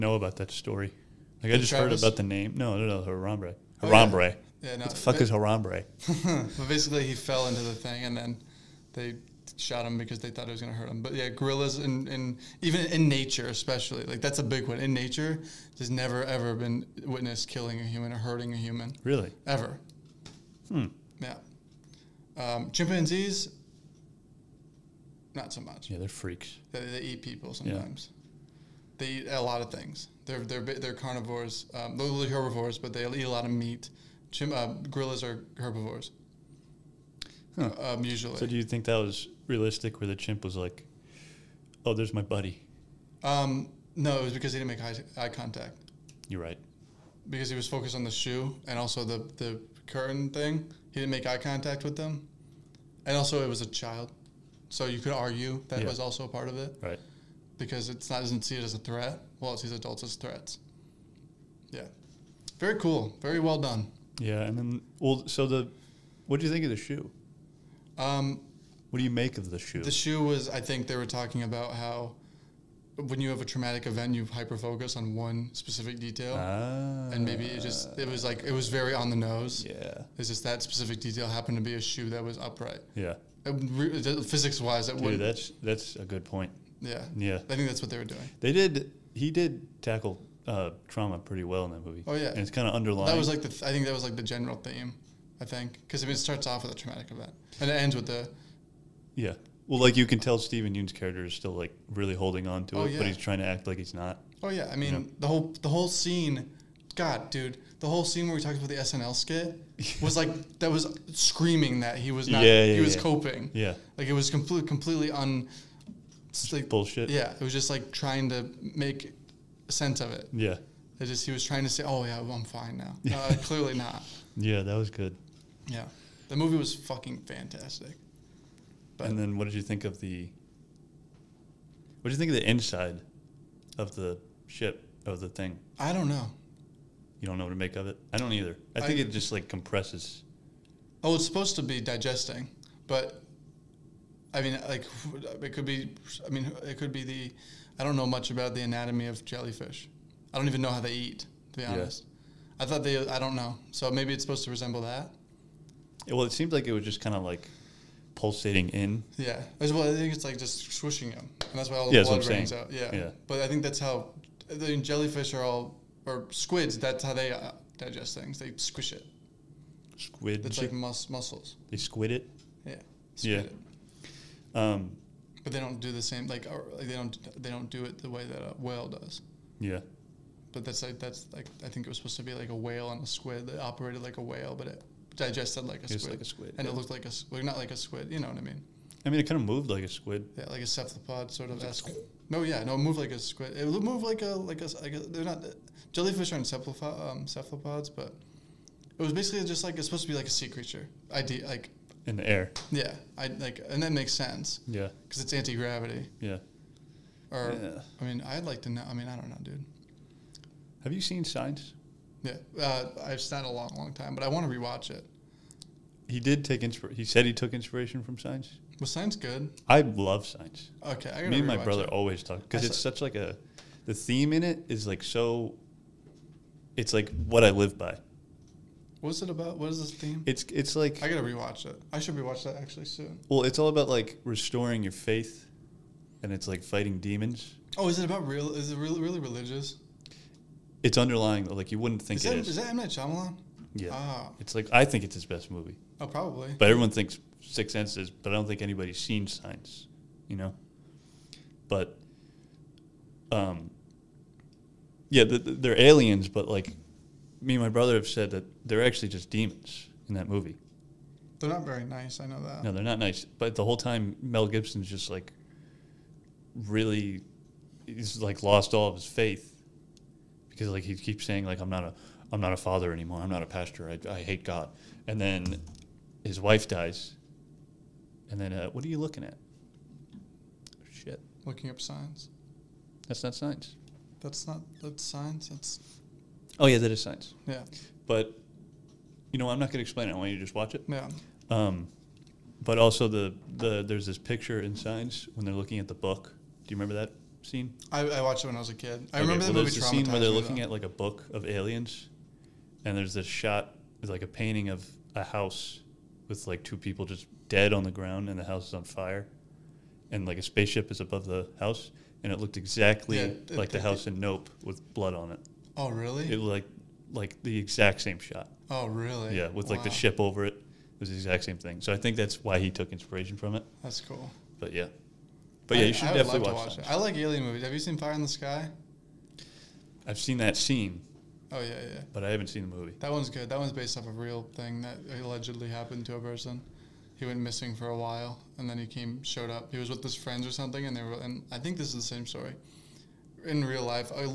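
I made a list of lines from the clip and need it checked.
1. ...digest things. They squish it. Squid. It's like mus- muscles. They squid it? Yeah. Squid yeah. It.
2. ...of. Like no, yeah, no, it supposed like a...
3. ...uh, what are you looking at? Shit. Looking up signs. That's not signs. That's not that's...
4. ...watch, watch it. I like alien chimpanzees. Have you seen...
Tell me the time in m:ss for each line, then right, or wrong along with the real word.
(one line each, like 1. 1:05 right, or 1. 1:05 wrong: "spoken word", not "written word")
1. 2:47 right
2. 3:11 wrong: "moved", not "supposed"
3. 4:38 right
4. 5:26 wrong: "movies", not "chimpanzees".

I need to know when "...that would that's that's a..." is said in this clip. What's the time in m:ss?
1:24.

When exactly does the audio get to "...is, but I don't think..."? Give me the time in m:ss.
4:07.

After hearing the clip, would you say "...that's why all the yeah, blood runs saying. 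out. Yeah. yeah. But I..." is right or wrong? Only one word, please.
right.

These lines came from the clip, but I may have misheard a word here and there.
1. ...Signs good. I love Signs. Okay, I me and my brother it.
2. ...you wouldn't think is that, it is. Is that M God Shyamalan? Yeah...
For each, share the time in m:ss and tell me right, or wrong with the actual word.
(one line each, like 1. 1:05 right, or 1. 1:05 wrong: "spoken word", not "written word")
1. 3:38 right
2. 4:01 wrong: "Night", not "God".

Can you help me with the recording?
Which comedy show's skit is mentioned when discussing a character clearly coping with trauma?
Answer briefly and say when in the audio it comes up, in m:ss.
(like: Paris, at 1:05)
SNL, at 1:48.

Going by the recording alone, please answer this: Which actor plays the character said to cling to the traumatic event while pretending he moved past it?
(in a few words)
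Steven Yeun.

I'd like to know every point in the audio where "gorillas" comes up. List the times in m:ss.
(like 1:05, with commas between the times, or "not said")
0:11, 0:34.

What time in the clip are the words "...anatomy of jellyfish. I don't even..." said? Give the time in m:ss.
2:28.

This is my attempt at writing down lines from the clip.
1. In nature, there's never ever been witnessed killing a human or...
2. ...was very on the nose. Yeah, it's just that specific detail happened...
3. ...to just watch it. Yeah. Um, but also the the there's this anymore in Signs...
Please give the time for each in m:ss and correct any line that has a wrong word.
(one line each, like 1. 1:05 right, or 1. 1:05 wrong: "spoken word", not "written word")
1. 0:14 right
2. 1:18 right
3. 4:50 wrong: "picture", not "anymore".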